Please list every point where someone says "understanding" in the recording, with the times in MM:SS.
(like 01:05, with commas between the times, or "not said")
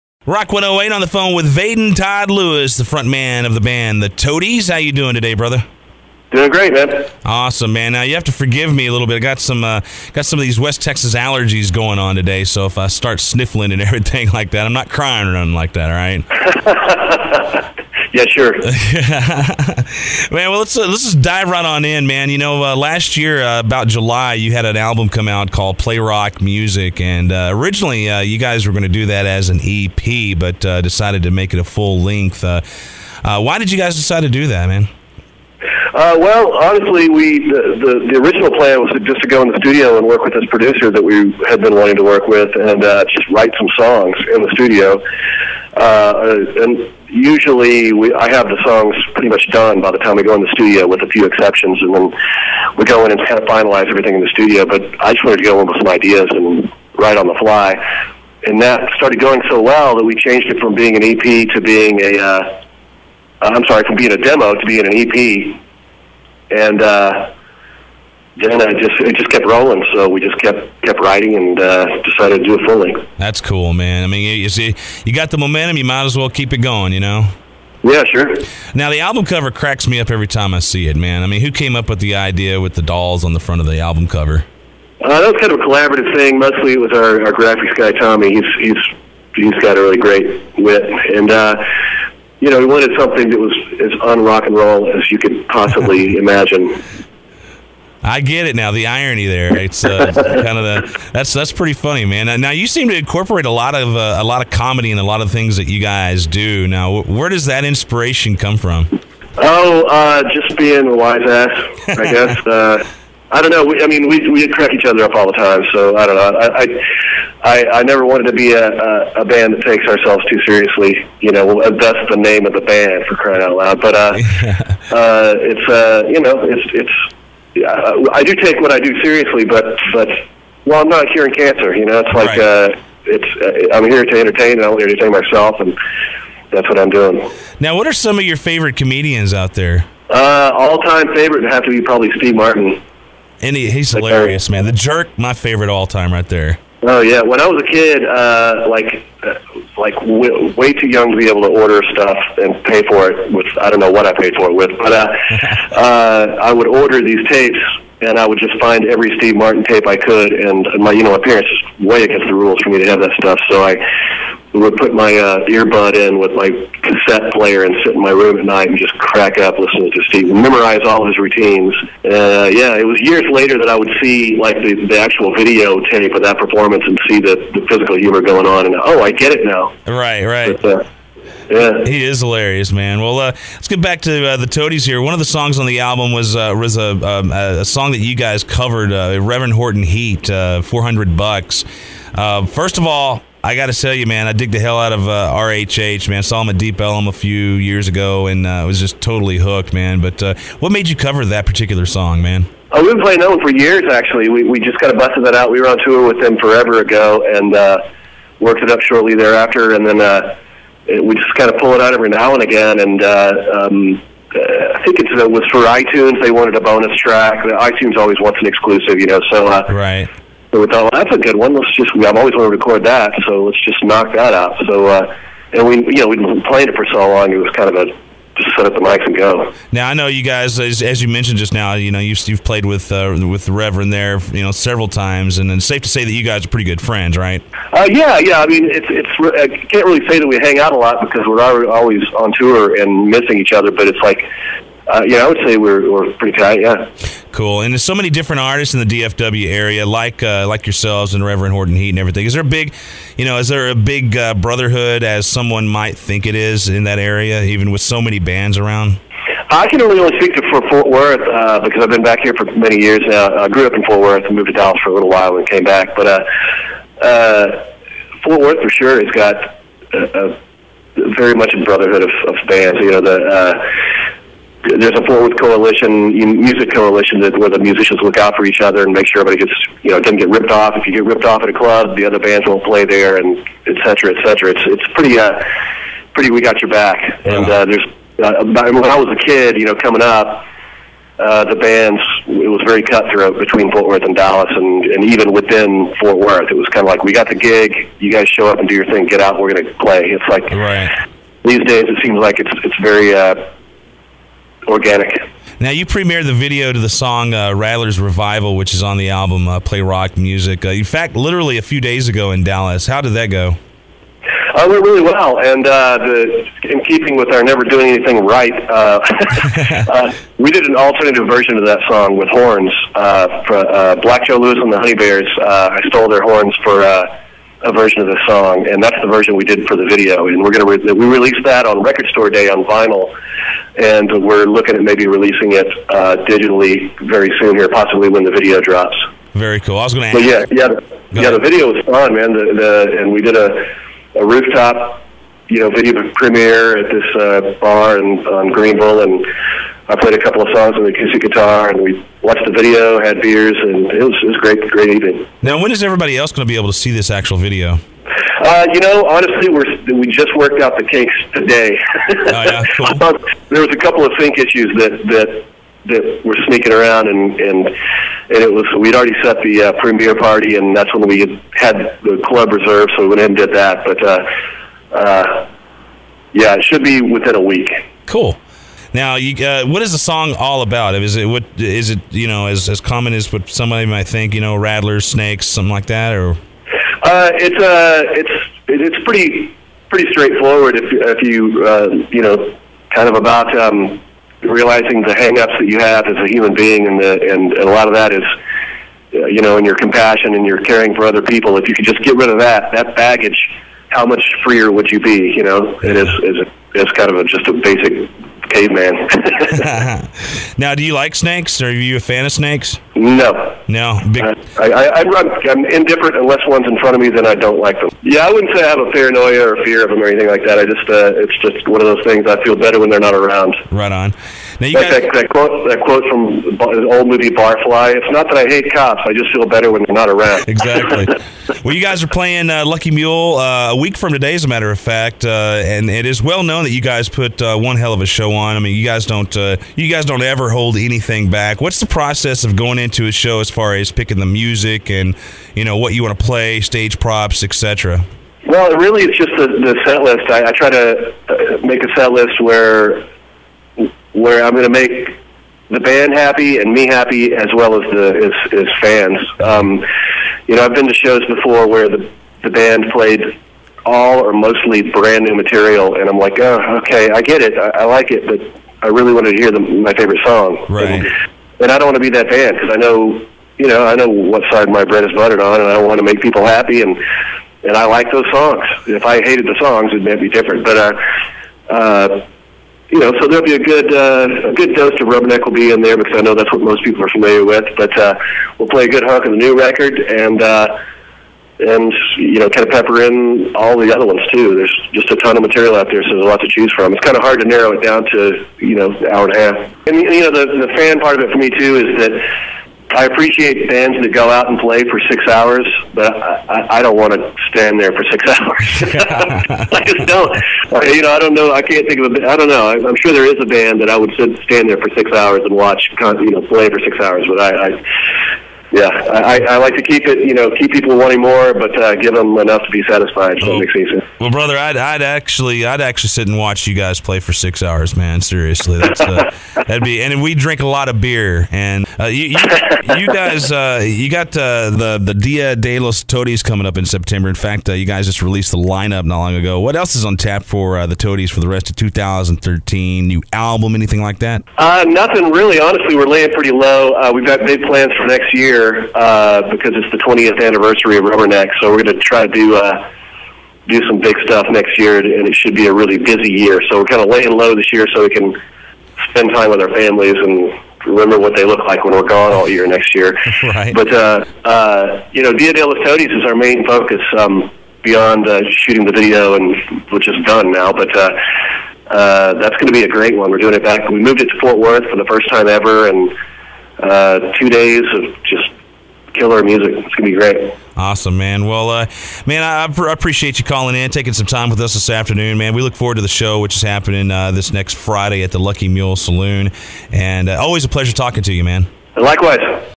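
not said.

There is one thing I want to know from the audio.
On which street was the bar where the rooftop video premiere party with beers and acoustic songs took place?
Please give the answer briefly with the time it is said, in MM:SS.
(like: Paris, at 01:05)
Greenville, at 05:48.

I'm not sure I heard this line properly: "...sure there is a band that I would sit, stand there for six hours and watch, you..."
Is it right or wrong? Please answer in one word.
right.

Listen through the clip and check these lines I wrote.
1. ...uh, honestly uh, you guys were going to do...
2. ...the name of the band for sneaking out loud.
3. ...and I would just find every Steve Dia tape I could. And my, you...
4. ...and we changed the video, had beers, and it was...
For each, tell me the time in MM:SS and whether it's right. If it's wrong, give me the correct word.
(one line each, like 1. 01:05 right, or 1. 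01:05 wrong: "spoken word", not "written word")
1. 00:27 wrong: "originally", not "honestly"
2. 02:02 wrong: "crying", not "sneaking"
3. 02:38 wrong: "Martin", not "Dia"
4. 05:51 wrong: "watched", not "changed".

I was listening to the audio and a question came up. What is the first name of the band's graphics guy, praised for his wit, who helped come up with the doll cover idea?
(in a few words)
Tommy.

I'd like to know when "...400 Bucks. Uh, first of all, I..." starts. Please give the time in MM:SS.
03:10.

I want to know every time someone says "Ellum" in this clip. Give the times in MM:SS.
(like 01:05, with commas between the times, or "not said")
03:16.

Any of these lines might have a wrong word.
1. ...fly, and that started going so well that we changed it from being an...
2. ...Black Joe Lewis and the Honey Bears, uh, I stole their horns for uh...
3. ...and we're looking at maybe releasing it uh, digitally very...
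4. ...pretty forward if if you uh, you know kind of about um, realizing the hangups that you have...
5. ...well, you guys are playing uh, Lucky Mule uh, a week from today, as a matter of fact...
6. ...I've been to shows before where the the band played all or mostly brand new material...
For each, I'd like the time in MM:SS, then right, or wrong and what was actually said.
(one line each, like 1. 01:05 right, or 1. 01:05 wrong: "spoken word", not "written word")
1. 00:57 right
2. 05:23 right
3. 05:33 right
4. 06:29 wrong: "straightforward", not "forward"
5. 07:11 right
6. 07:40 right.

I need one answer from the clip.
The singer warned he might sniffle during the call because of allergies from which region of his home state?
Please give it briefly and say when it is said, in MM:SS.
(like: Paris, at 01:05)
West Texas, at 00:10.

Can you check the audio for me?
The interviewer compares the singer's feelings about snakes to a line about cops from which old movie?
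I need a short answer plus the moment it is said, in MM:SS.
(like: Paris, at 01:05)
Barfly, at 07:07.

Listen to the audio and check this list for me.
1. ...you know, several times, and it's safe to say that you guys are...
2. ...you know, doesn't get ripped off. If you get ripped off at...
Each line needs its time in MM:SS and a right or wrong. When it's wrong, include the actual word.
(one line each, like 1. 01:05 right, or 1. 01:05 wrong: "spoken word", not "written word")
1. 03:54 right
2. 04:39 right.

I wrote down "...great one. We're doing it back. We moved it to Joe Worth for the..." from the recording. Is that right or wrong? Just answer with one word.
wrong.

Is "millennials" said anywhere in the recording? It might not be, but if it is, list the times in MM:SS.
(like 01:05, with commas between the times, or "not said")
not said.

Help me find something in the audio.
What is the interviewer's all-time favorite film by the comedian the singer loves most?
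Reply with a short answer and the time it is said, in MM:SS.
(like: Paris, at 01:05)
The Jerk, at 02:24.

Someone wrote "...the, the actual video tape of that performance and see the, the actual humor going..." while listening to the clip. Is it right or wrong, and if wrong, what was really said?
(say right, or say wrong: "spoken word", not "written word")
wrong: "physical", not "actual".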